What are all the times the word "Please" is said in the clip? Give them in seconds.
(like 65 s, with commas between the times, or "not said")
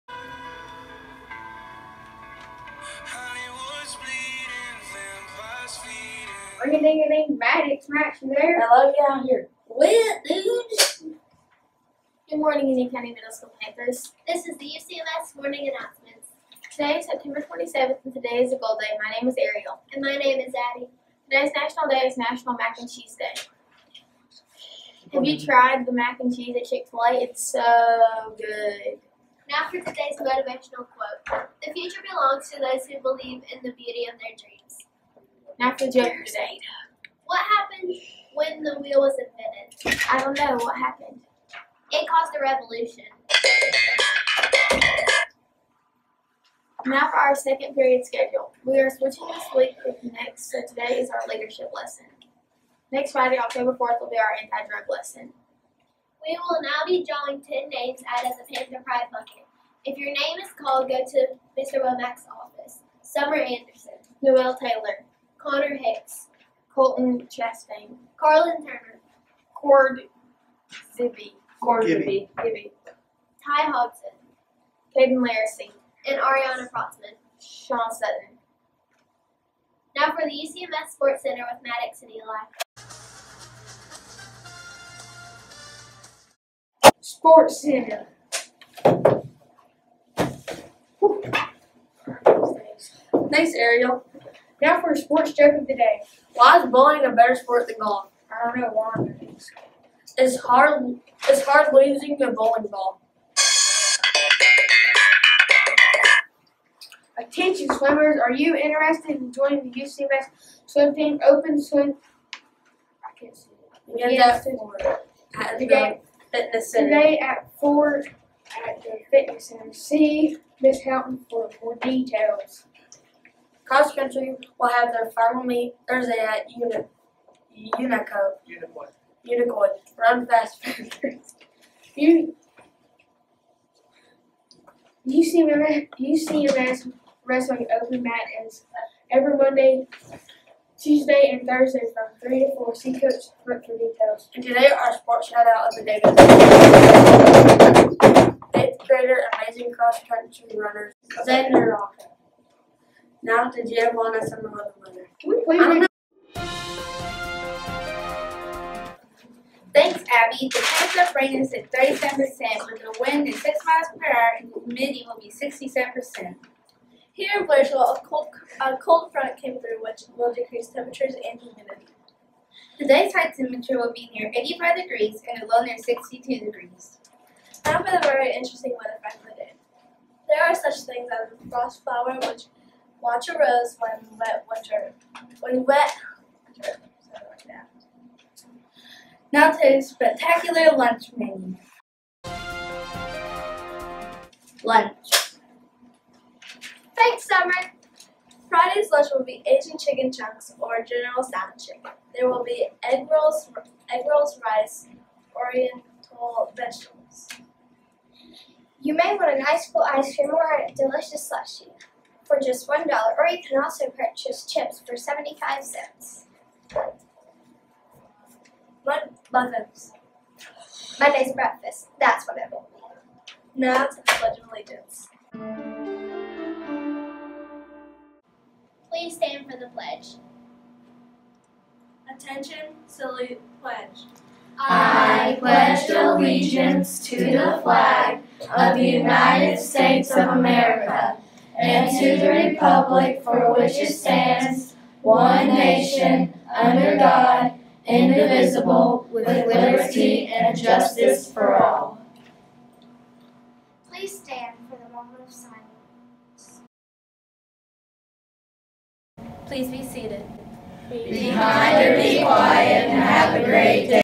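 253 s, 259 s.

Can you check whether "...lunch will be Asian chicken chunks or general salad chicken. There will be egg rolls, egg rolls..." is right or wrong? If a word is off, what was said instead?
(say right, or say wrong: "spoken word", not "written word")
right.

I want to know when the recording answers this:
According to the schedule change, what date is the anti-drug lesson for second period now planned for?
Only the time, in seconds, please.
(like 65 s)
53 s.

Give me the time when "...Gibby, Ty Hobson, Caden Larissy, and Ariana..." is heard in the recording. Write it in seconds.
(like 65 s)
72 s.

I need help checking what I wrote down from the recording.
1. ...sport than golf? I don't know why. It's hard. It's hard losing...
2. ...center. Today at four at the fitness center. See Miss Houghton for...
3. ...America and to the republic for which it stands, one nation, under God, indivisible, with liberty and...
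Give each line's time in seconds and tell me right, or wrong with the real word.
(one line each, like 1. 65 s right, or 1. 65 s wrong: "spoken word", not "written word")
1. 97 s right
2. 116 s right
3. 240 s right.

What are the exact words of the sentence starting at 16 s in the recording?
Today is September 27th, and today is a gold day.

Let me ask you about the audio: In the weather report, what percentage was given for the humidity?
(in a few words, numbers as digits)
67%.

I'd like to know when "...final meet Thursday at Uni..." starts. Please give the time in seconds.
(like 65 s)
125 s.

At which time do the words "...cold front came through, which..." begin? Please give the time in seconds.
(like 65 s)
168 s.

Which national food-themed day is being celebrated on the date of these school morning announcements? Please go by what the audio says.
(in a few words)
National Mac and Cheese Day.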